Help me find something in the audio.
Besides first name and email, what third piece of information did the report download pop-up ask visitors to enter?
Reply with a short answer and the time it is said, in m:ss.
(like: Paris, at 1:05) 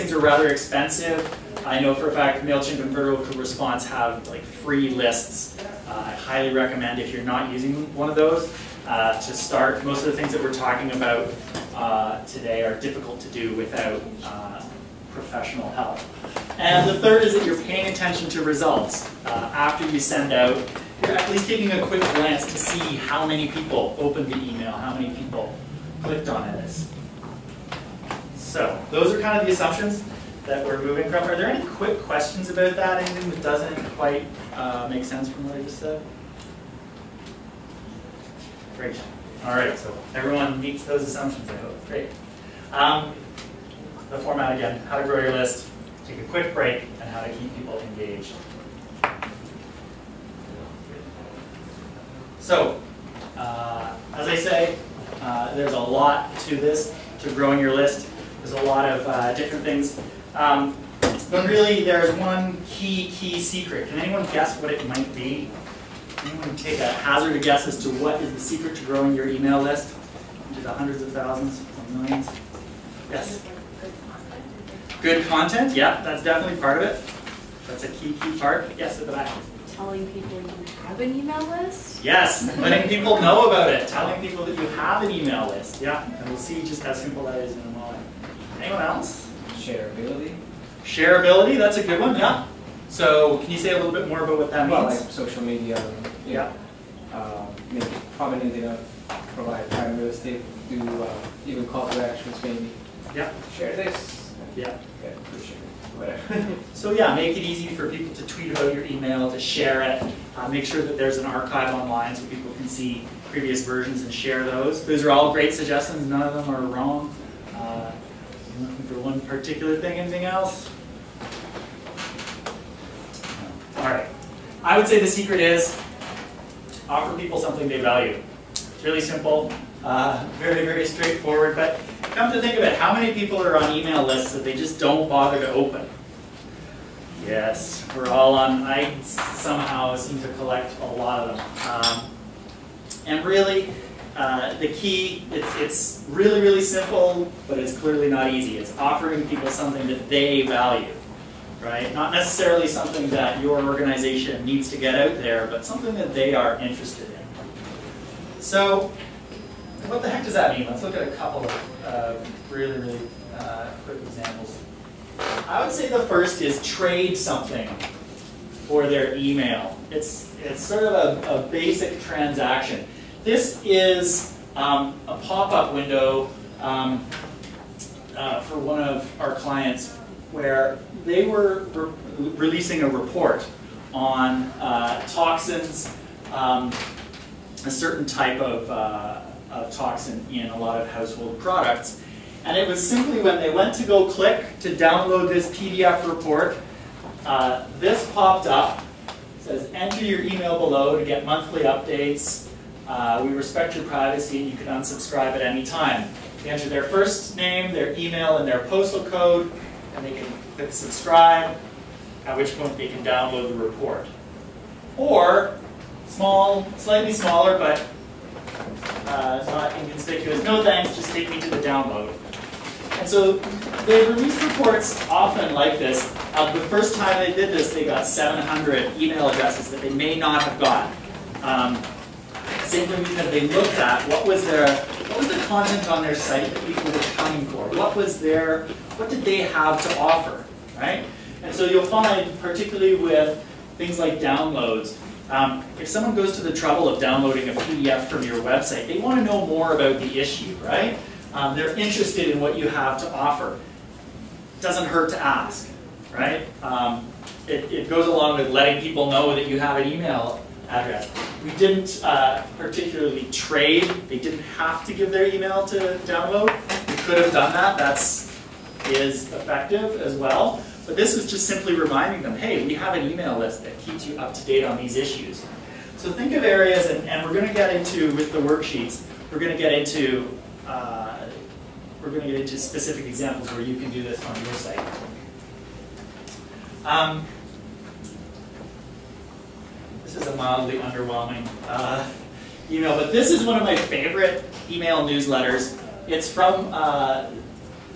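postal code, at 3:28.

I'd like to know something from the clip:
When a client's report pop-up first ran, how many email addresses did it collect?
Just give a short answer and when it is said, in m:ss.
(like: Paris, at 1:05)
700, at 3:48.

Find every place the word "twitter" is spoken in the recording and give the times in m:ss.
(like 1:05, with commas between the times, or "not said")
not said.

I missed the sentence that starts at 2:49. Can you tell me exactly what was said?
It's, it's sort of a, a basic transaction.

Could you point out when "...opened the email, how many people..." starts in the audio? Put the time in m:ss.
0:23.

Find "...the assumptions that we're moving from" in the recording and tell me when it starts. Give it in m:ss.
0:29.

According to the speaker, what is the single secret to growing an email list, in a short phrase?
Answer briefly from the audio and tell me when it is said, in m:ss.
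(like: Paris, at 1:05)
something they value, at 2:07.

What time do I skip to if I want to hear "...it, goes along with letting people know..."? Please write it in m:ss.
4:17.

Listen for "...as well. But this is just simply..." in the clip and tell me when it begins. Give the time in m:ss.
4:30.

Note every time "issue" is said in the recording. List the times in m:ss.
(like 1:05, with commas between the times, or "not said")
4:10, 4:34.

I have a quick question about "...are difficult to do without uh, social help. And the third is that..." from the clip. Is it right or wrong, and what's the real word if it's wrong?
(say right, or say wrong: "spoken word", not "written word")
wrong: "professional", not "social".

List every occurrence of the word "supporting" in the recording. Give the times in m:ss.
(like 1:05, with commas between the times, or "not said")
not said.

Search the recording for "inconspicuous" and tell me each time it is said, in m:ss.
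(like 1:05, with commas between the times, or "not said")
3:39.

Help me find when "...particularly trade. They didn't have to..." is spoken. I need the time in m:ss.
4:22.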